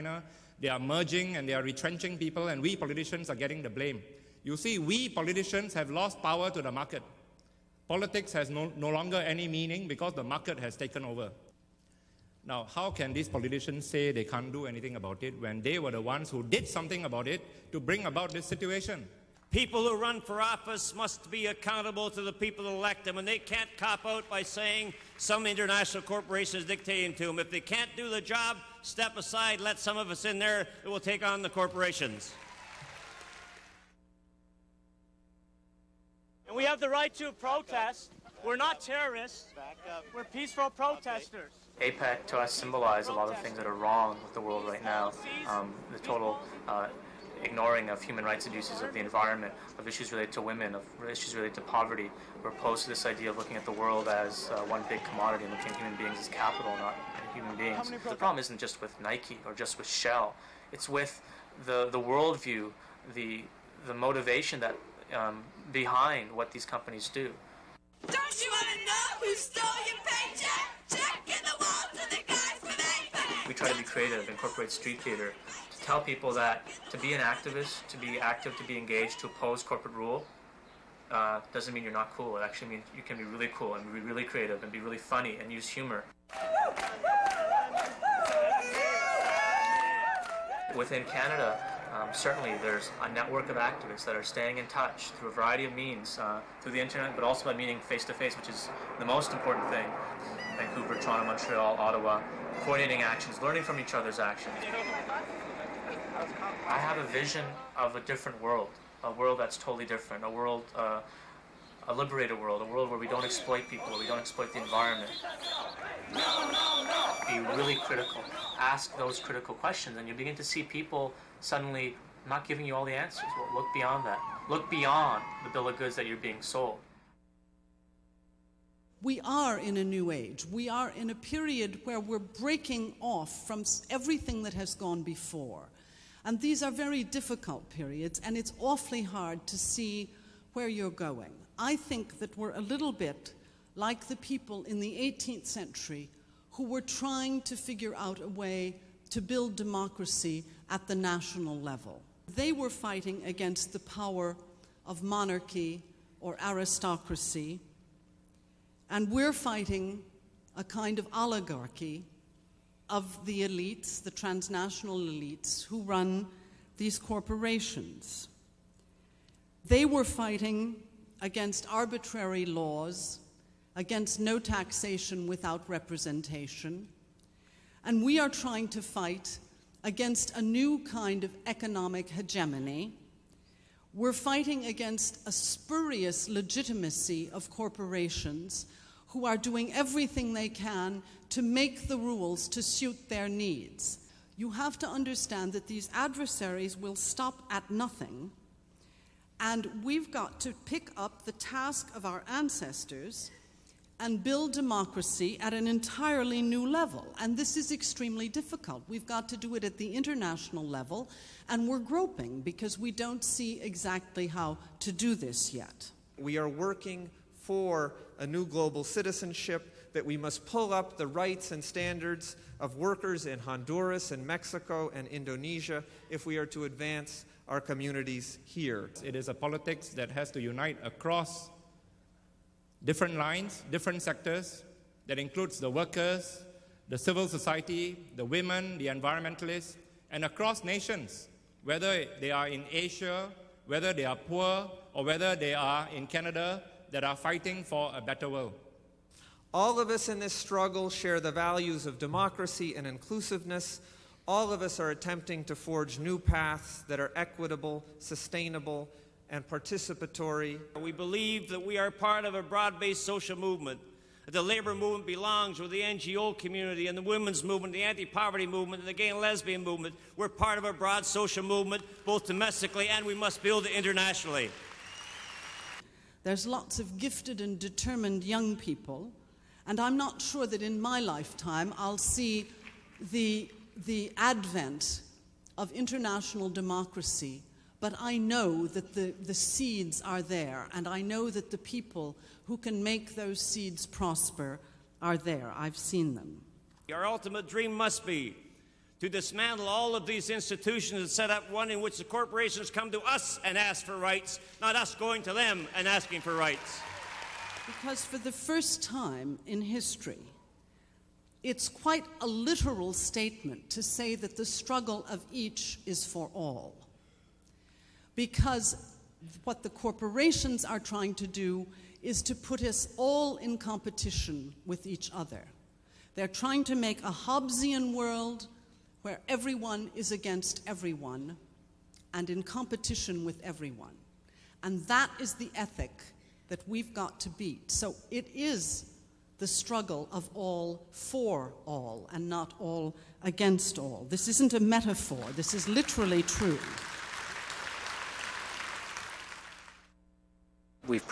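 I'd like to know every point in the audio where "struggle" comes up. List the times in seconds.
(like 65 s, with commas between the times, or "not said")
250 s, 314 s, 339 s.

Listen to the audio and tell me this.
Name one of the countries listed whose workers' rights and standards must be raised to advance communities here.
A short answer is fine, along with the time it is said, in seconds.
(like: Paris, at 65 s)
Honduras, at 223 s.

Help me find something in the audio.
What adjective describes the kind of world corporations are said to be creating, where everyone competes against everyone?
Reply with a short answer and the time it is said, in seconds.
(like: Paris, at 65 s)
Hobbesian, at 327 s.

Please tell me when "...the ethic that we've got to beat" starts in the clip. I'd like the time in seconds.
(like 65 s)
335 s.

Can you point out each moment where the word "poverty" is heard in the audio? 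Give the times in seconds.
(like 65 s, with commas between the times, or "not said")
51 s, 268 s.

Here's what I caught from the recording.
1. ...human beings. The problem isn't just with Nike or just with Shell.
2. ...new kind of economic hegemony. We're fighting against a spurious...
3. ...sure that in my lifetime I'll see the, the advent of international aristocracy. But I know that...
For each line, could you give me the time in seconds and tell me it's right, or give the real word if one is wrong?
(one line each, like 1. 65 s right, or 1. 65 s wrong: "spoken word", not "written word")
1. 57 s right
2. 180 s right
3. 280 s wrong: "democracy", not "aristocracy".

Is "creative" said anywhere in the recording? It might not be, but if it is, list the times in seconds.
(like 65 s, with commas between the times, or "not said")
73 s, 84 s.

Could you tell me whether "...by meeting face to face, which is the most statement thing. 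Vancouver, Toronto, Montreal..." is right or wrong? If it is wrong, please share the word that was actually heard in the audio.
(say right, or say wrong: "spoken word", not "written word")
wrong: "important", not "statement".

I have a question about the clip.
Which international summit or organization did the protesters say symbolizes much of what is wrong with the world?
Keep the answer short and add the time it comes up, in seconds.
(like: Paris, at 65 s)
APEC, at 41 s.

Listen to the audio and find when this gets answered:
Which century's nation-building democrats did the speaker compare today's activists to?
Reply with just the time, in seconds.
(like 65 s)
144 s.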